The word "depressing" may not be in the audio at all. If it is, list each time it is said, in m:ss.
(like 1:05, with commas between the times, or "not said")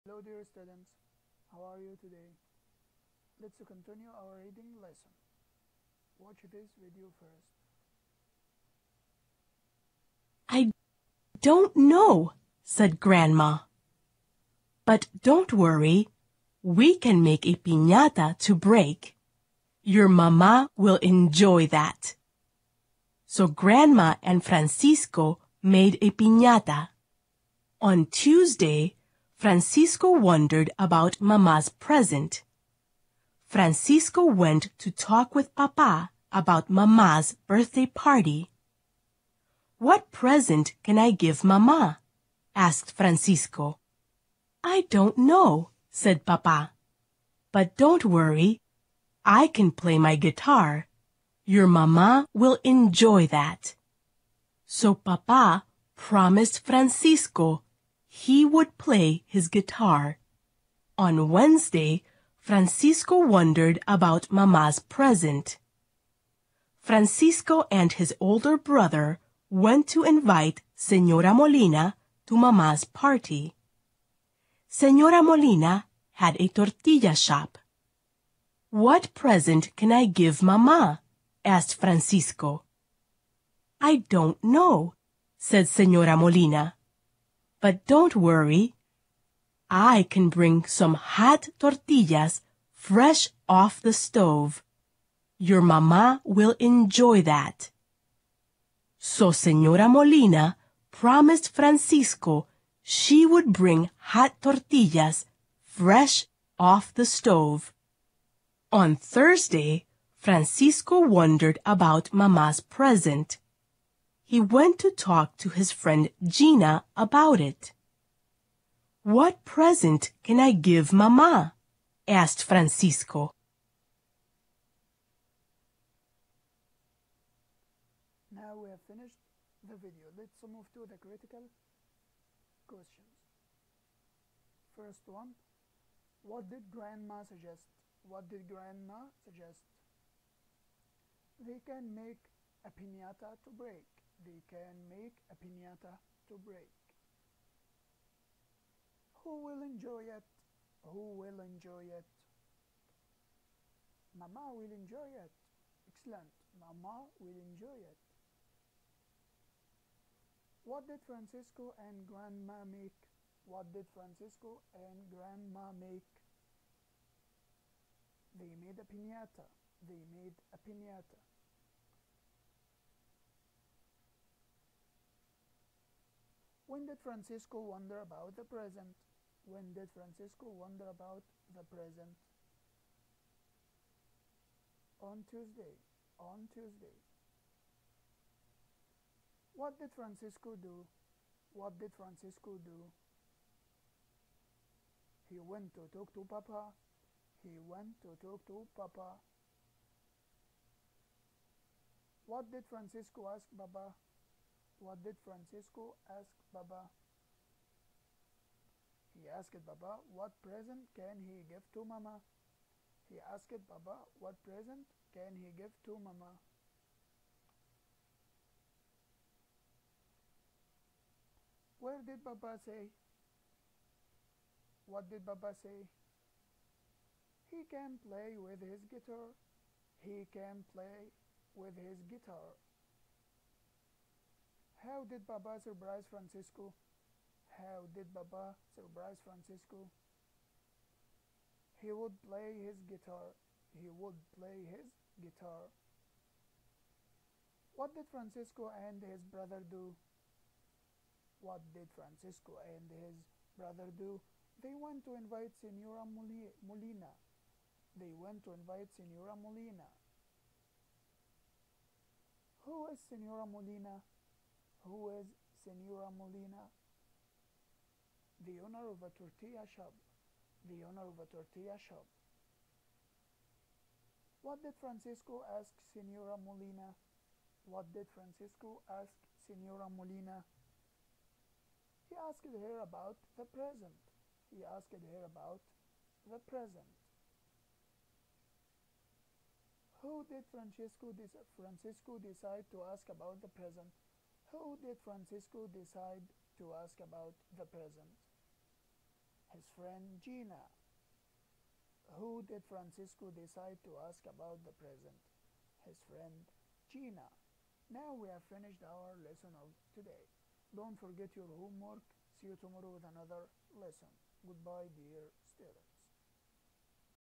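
not said.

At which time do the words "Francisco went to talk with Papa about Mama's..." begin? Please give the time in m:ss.
0:33.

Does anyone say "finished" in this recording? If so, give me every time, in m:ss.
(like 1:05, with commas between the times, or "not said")
2:08, 5:08.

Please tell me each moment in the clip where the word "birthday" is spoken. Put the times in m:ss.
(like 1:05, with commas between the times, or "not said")
0:37.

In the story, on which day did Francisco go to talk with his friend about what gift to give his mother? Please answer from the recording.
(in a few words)
Thursday.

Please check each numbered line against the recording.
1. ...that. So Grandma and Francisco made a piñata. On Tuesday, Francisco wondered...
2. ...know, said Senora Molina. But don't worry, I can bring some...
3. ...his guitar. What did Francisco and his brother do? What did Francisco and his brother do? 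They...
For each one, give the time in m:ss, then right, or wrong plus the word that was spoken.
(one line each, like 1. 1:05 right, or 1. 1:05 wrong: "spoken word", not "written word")
1. 0:21 right
2. 1:24 right
3. 4:04 right.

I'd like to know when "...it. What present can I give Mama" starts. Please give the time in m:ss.
1:57.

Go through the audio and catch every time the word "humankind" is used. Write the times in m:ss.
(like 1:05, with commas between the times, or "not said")
not said.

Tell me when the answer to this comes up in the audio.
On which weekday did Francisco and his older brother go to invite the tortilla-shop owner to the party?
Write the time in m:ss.
1:01.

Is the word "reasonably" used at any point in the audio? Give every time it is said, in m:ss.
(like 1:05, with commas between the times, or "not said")
not said.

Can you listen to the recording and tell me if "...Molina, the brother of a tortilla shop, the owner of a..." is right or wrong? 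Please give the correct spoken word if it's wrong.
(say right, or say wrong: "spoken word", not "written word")
wrong: "owner", not "brother".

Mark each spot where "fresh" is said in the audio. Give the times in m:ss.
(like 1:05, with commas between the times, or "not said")
1:32, 1:45.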